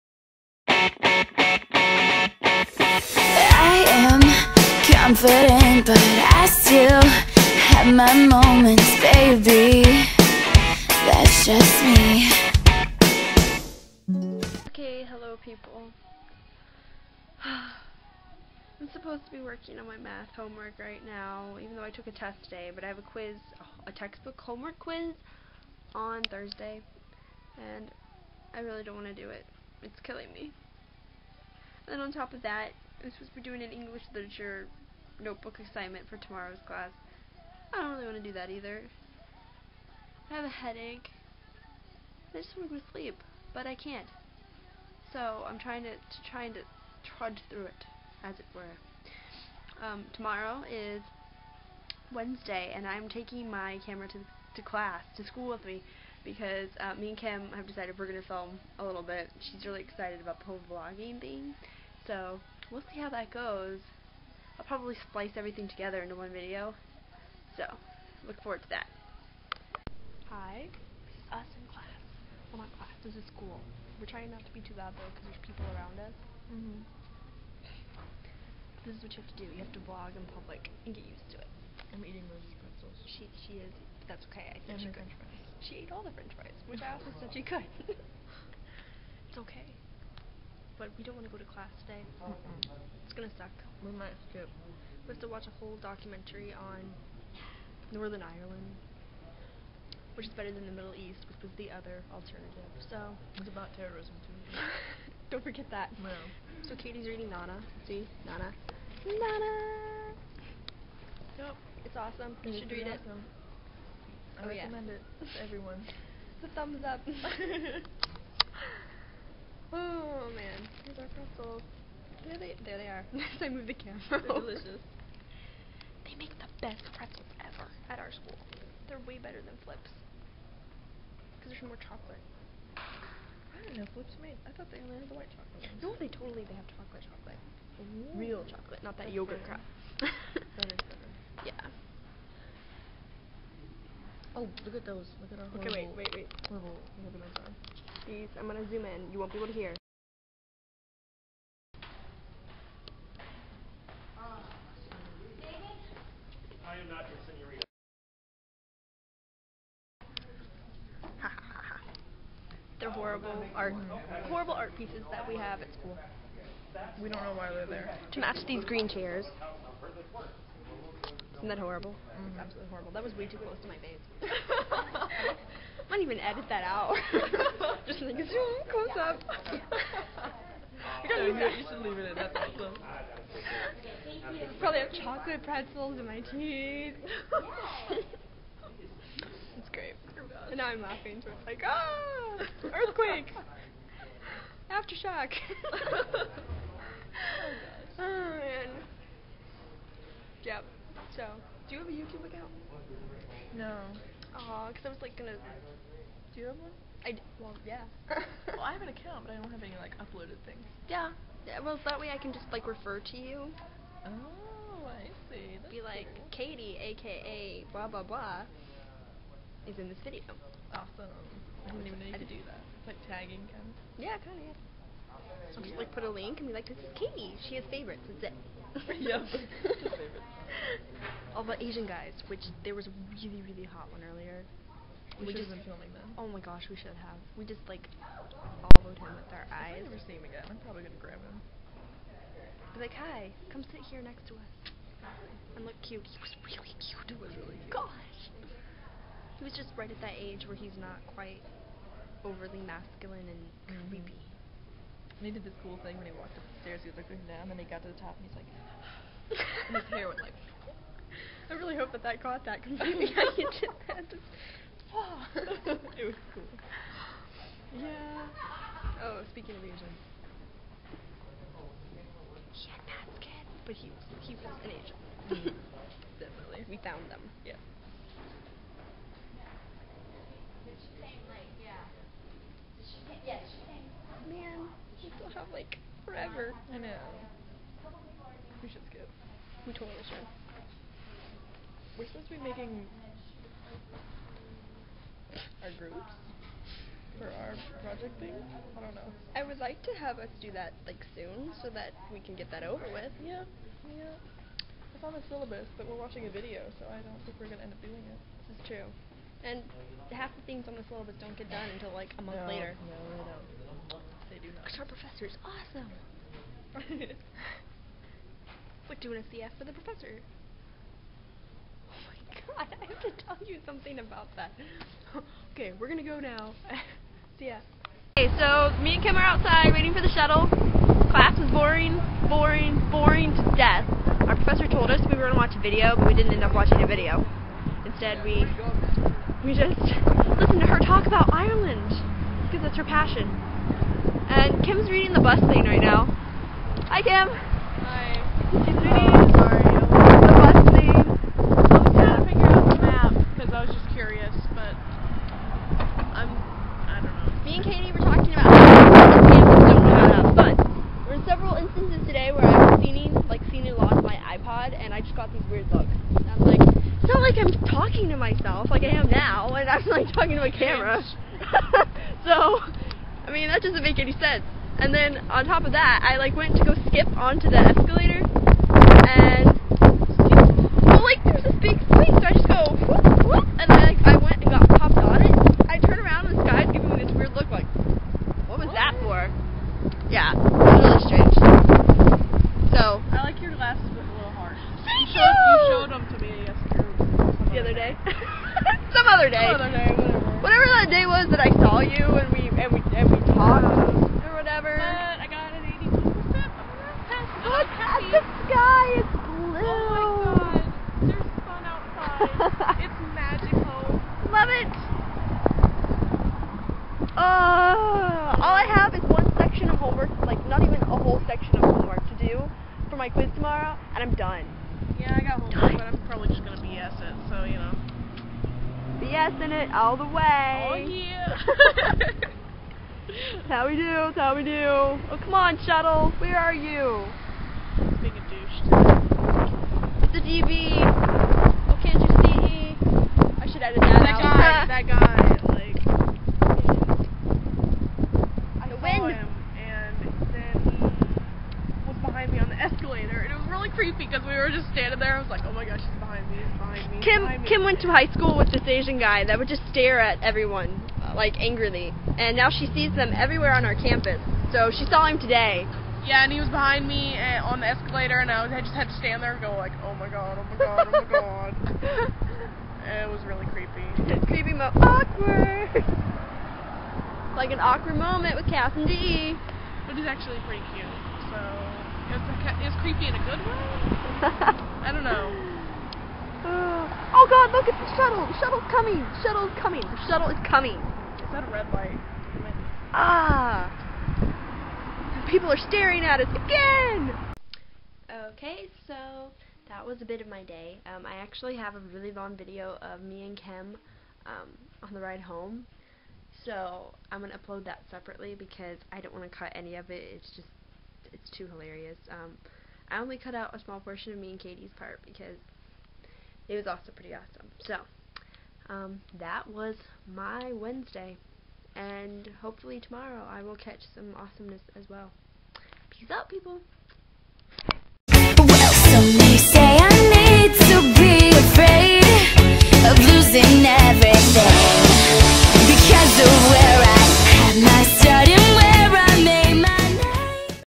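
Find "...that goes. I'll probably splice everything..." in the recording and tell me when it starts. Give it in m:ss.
1:03.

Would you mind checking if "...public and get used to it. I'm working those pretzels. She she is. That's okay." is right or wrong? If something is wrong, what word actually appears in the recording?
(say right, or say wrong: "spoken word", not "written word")
wrong: "eating", not "working".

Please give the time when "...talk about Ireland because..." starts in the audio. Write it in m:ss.
5:40.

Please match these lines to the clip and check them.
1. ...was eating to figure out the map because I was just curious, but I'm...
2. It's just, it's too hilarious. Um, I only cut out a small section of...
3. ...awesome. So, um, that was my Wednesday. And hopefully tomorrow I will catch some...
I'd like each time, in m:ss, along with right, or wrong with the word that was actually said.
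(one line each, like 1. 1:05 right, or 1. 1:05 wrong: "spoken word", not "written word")
1. 5:51 wrong: "trying", not "eating"
2. 8:30 wrong: "portion", not "section"
3. 8:37 right.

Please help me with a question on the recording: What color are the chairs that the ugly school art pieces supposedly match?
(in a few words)
Green.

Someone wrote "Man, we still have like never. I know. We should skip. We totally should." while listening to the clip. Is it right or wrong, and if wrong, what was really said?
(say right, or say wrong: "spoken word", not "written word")
wrong: "forever", not "never".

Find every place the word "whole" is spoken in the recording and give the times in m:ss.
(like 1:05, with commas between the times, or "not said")
1:00, 1:35, 7:00.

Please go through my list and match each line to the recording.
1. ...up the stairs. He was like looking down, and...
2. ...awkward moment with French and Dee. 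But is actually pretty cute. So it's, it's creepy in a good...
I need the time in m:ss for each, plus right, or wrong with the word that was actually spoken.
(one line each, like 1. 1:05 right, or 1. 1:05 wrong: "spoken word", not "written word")
1. 4:16 right
2. 7:57 wrong: "Cass", not "French".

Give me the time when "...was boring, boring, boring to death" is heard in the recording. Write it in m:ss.
5:31.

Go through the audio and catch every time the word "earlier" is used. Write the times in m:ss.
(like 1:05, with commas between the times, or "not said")
3:54.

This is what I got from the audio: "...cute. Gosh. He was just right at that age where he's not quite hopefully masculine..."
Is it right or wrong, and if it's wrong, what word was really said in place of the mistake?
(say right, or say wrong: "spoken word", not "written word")
wrong: "overly", not "hopefully".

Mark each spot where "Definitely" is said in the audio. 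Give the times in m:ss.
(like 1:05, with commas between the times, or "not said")
4:36.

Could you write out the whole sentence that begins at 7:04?
Yeah, I got homework, but I'm probably just gonna BS it, so you know.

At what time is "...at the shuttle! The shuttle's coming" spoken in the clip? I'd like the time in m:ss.
8:07.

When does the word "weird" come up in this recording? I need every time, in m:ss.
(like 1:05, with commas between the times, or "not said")
6:05, 6:27.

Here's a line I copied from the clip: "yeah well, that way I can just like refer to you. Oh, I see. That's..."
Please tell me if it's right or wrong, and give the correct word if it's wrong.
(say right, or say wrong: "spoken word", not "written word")
right.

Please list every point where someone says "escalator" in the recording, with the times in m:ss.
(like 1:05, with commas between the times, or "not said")
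6:17, 7:32, 7:47.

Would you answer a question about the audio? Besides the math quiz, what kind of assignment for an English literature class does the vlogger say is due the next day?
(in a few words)
Notebook assignment.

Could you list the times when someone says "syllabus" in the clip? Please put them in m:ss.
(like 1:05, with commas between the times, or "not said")
5:05, 5:10.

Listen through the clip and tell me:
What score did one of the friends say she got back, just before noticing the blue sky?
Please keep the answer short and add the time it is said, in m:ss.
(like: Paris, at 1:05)
82%, at 6:45.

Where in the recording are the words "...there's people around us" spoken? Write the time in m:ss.
1:15.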